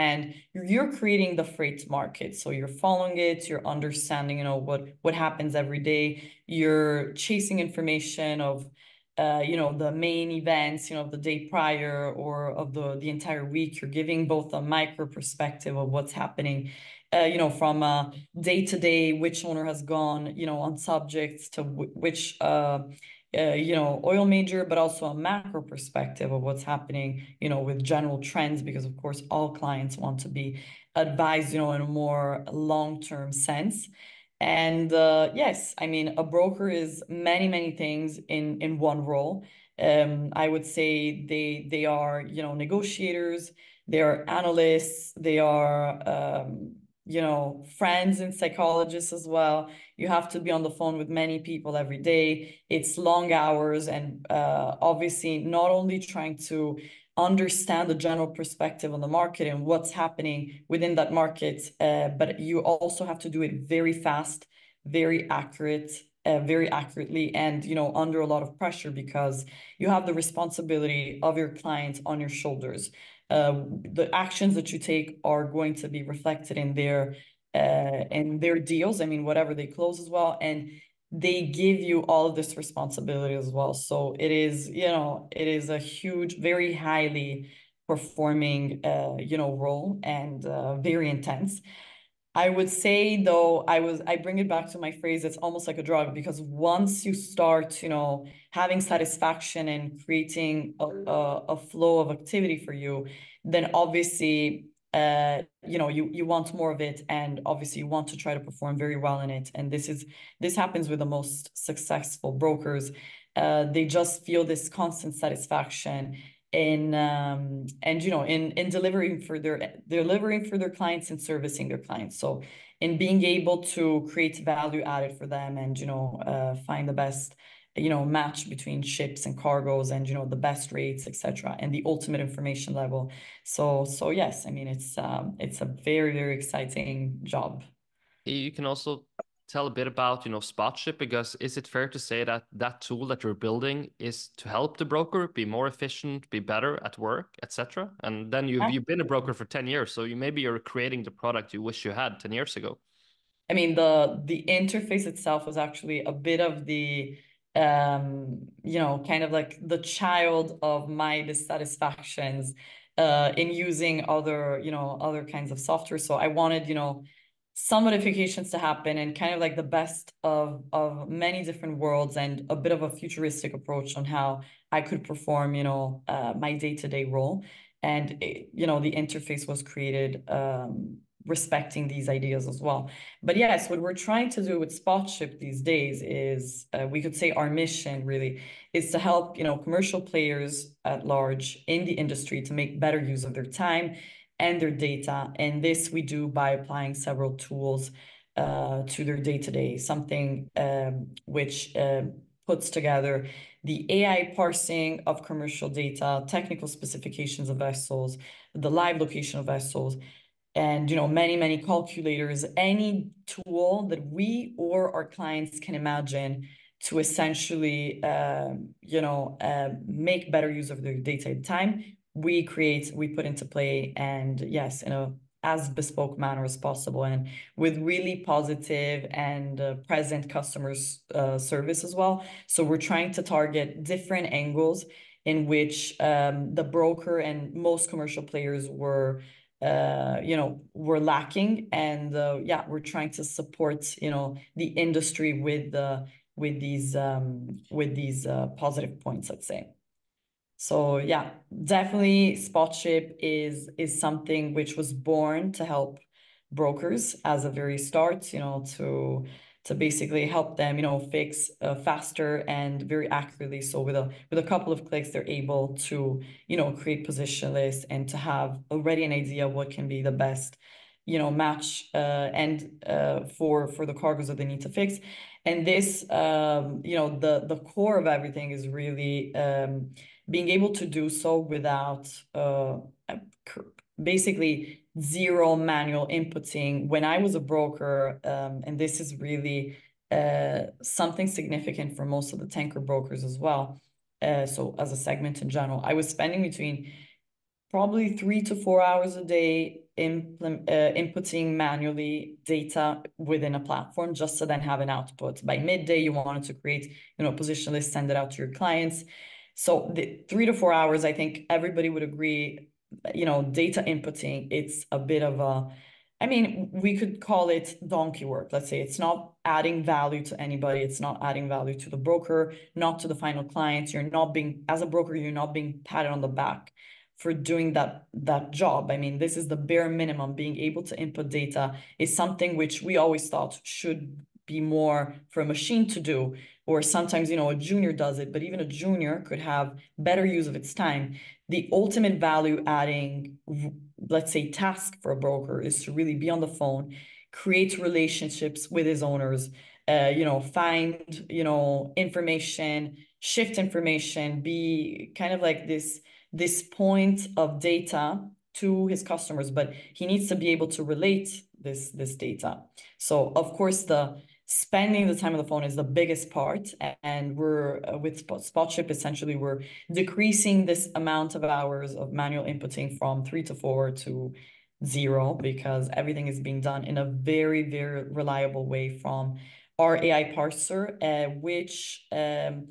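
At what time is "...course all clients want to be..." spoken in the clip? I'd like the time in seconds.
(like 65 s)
28 s.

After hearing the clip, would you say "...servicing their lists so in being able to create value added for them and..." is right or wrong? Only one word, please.
wrong.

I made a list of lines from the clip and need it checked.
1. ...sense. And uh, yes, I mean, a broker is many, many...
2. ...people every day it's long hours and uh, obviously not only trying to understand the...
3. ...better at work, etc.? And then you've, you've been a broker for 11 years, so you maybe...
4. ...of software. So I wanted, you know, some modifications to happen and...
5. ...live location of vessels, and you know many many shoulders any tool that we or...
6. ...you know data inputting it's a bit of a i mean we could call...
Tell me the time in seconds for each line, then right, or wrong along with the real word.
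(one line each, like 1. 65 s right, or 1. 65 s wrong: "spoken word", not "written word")
1. 33 s right
2. 51 s right
3. 146 s wrong: "10", not "11"
4. 165 s right
5. 208 s wrong: "calculators", not "shoulders"
6. 313 s right.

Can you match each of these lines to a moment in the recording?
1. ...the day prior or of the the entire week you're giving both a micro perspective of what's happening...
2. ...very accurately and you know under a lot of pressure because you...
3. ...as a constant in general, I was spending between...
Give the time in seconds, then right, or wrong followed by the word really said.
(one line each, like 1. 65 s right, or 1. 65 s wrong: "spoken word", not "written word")
1. 11 s right
2. 66 s right
3. 294 s wrong: "segment", not "constant".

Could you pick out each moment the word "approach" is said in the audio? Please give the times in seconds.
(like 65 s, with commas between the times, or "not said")
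173 s.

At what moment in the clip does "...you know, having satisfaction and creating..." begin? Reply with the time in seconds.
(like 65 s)
97 s.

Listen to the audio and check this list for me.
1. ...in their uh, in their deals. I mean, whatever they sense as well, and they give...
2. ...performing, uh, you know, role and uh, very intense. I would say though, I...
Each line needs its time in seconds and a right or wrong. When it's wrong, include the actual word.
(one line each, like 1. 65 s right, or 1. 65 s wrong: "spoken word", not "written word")
1. 76 s wrong: "close", not "sense"
2. 87 s right.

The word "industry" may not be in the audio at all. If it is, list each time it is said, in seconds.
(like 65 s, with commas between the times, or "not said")
191 s, 244 s.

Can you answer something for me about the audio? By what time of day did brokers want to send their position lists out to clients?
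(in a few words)
Midday.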